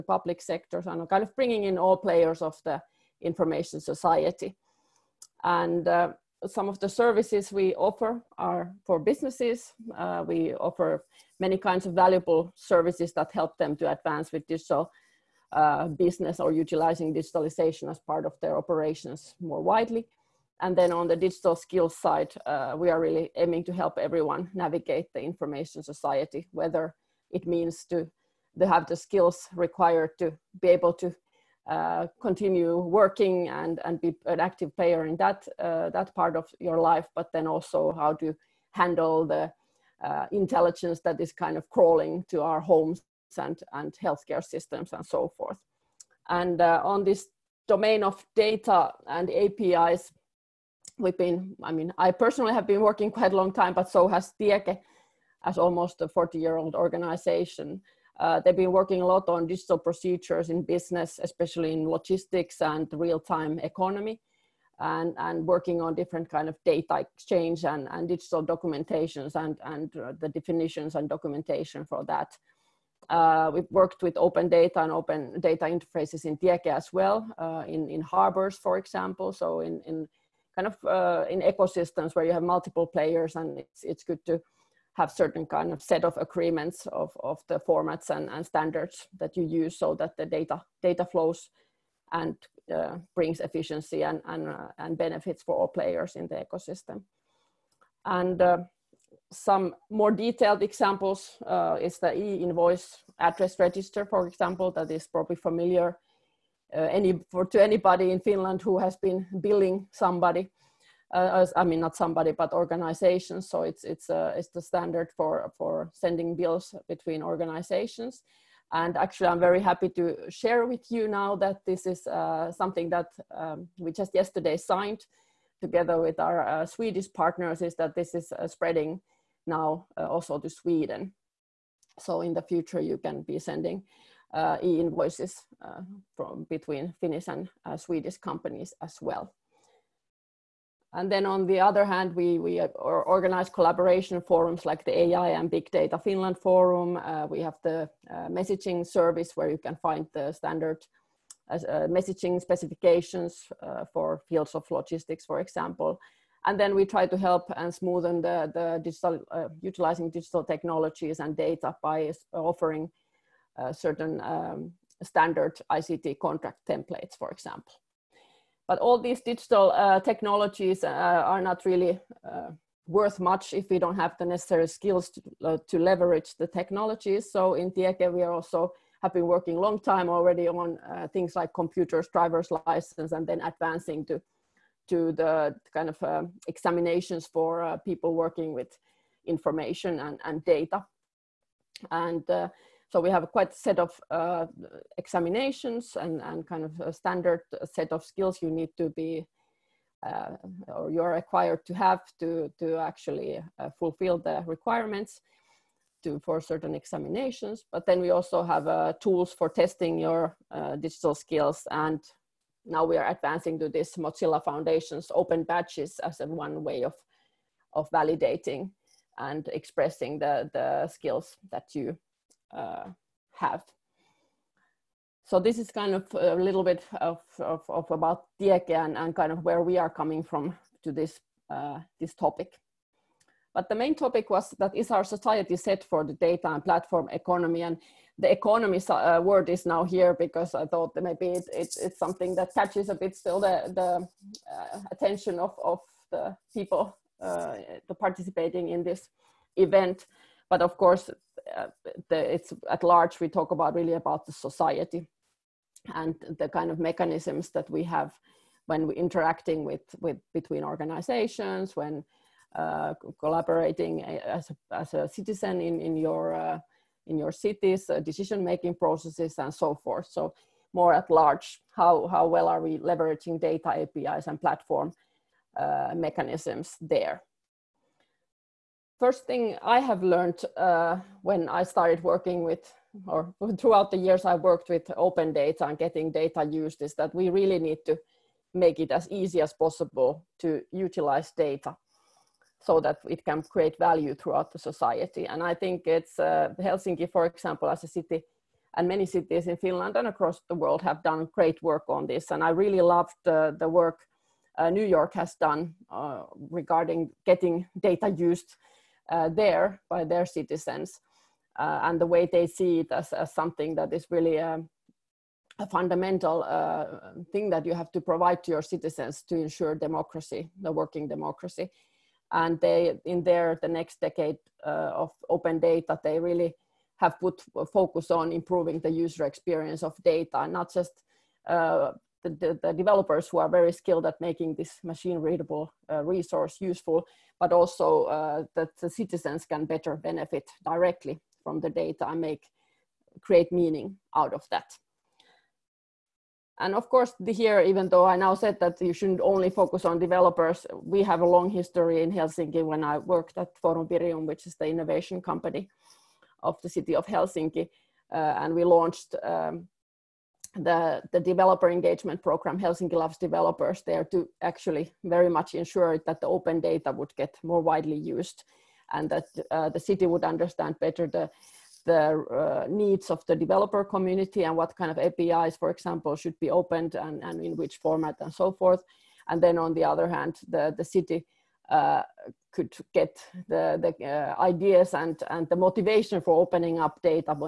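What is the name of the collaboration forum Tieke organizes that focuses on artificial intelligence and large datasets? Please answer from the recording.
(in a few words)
AI and Big Data Finland Forum.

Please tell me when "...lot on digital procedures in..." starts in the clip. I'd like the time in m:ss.
0:59.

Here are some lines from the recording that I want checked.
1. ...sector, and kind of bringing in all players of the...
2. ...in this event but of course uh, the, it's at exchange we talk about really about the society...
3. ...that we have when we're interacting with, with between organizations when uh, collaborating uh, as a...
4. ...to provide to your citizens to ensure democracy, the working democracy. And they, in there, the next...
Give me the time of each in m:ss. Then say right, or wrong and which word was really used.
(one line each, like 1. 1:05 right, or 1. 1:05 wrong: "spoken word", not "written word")
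1. 0:00 right
2. 4:08 wrong: "large", not "exchange"
3. 4:17 right
4. 5:17 right.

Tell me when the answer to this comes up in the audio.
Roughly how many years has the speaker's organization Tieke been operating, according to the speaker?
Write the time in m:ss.
0:55.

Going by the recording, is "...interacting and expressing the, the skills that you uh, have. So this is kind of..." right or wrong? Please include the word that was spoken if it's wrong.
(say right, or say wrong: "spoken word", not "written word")
wrong: "validating", not "interacting".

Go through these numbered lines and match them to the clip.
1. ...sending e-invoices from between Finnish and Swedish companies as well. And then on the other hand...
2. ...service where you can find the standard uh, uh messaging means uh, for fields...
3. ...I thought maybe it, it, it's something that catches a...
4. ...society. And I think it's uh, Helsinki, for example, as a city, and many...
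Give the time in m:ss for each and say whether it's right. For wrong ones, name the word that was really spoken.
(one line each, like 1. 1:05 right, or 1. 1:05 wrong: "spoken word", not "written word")
1. 2:13 right
2. 2:28 wrong: "specifications", not "means"
3. 4:00 right
4. 4:54 right.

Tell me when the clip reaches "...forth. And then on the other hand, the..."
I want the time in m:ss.
6:18.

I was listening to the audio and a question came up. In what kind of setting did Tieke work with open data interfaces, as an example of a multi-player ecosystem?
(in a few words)
harbors.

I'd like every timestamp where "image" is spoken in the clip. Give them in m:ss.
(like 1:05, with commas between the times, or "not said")
not said.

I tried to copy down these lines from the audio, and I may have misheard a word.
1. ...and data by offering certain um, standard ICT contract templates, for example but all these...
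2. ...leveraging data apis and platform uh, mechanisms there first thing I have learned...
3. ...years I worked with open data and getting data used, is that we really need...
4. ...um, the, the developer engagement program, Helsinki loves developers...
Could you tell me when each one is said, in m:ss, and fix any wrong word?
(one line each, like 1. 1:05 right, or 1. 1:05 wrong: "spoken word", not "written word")
1. 2:41 right
2. 4:32 right
3. 4:44 right
4. 5:59 right.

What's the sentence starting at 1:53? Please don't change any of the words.
So it's it's uh, it's the standard for for sending bills between organizations.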